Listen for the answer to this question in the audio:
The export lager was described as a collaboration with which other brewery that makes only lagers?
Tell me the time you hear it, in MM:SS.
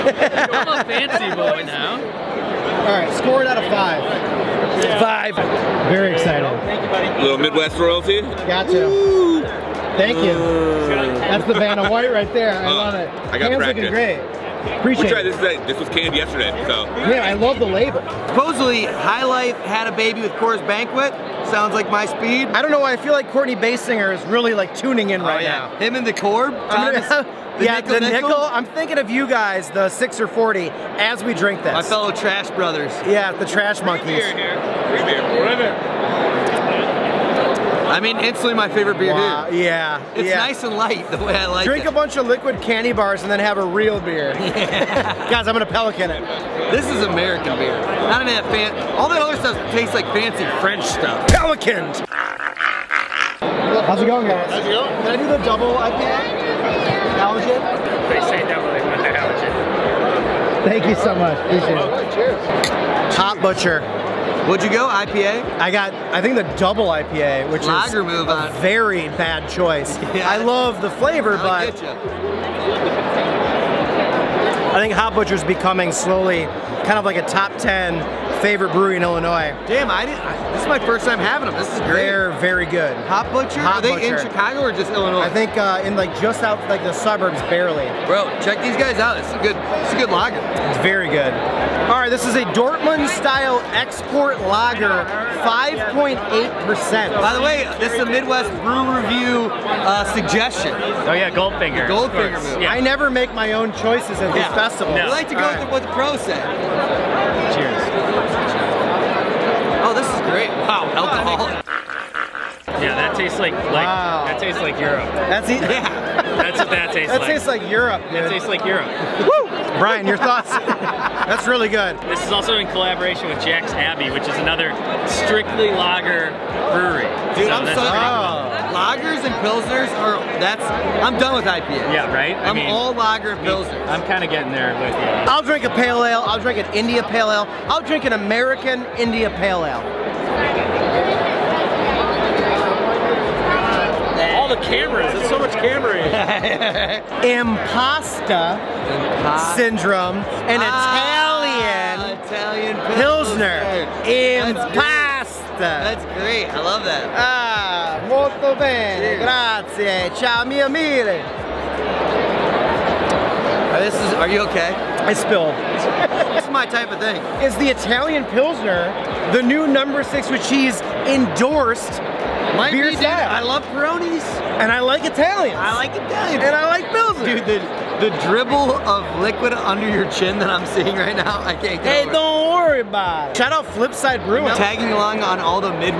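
02:03.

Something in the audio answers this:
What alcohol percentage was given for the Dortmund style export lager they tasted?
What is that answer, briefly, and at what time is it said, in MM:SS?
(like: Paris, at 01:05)
5.8%, at 01:35.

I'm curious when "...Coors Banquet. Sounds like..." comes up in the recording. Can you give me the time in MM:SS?
00:20.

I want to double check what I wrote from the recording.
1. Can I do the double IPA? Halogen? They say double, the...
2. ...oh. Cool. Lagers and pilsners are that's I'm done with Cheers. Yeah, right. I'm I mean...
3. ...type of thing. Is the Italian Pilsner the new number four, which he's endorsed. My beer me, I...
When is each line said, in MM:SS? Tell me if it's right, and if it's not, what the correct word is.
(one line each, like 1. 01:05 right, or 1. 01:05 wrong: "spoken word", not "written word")
1. 00:54 right
2. 02:07 wrong: "IPAs", not "Cheers"
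3. 02:46 wrong: "six", not "four".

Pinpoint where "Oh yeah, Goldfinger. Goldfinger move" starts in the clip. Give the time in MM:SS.
01:41.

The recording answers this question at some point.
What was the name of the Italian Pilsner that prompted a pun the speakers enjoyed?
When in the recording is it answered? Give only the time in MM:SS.
02:27.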